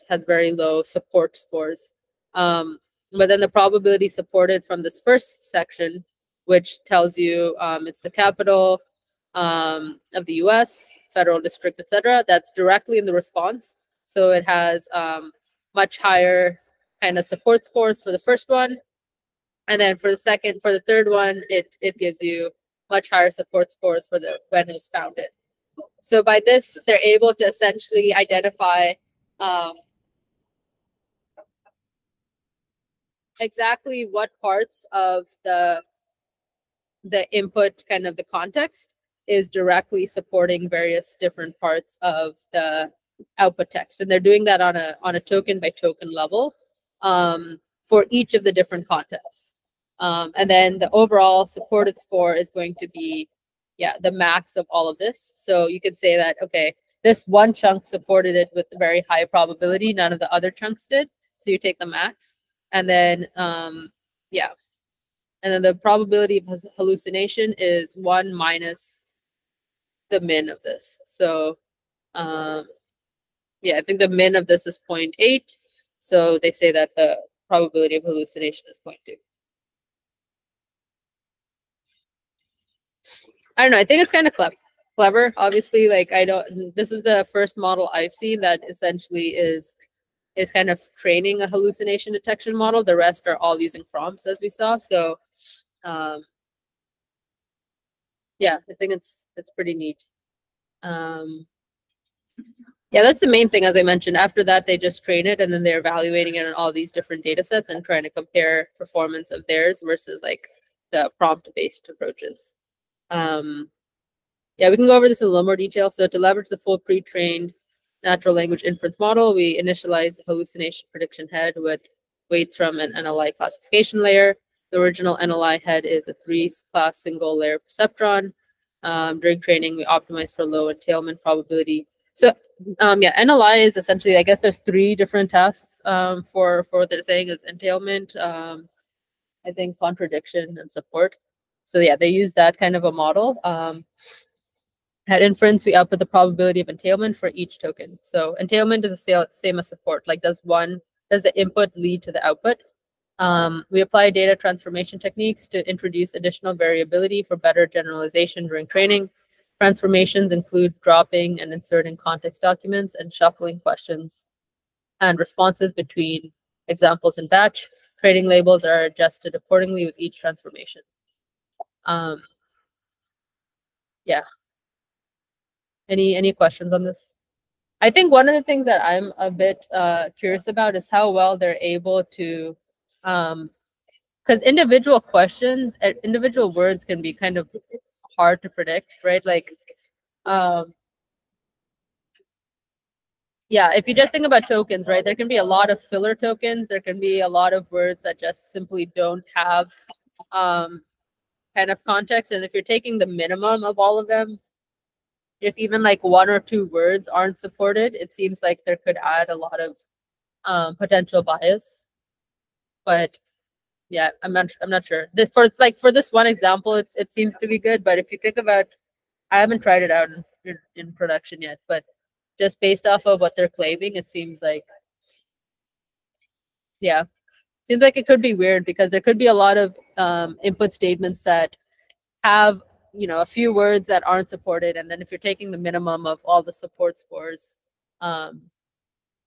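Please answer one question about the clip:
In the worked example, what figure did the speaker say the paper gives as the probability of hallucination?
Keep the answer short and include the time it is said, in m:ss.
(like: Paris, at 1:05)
0.2, at 1:18.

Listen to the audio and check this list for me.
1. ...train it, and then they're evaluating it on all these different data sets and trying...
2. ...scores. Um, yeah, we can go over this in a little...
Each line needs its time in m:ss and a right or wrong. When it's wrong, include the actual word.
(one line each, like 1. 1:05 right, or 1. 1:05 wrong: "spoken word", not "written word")
1. 1:45 right
2. 1:51 wrong: "approaches", not "scores".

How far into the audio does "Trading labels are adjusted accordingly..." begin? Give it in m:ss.
2:48.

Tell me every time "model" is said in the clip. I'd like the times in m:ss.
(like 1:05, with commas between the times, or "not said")
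1:27, 1:32, 1:58, 2:22.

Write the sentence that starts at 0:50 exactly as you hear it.
Um, and then the overall supported score is going to be, yeah, the max of all of this.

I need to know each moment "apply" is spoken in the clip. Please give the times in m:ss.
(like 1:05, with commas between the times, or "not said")
2:33.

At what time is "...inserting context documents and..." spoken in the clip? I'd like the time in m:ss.
2:41.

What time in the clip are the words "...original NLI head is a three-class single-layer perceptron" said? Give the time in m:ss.
2:04.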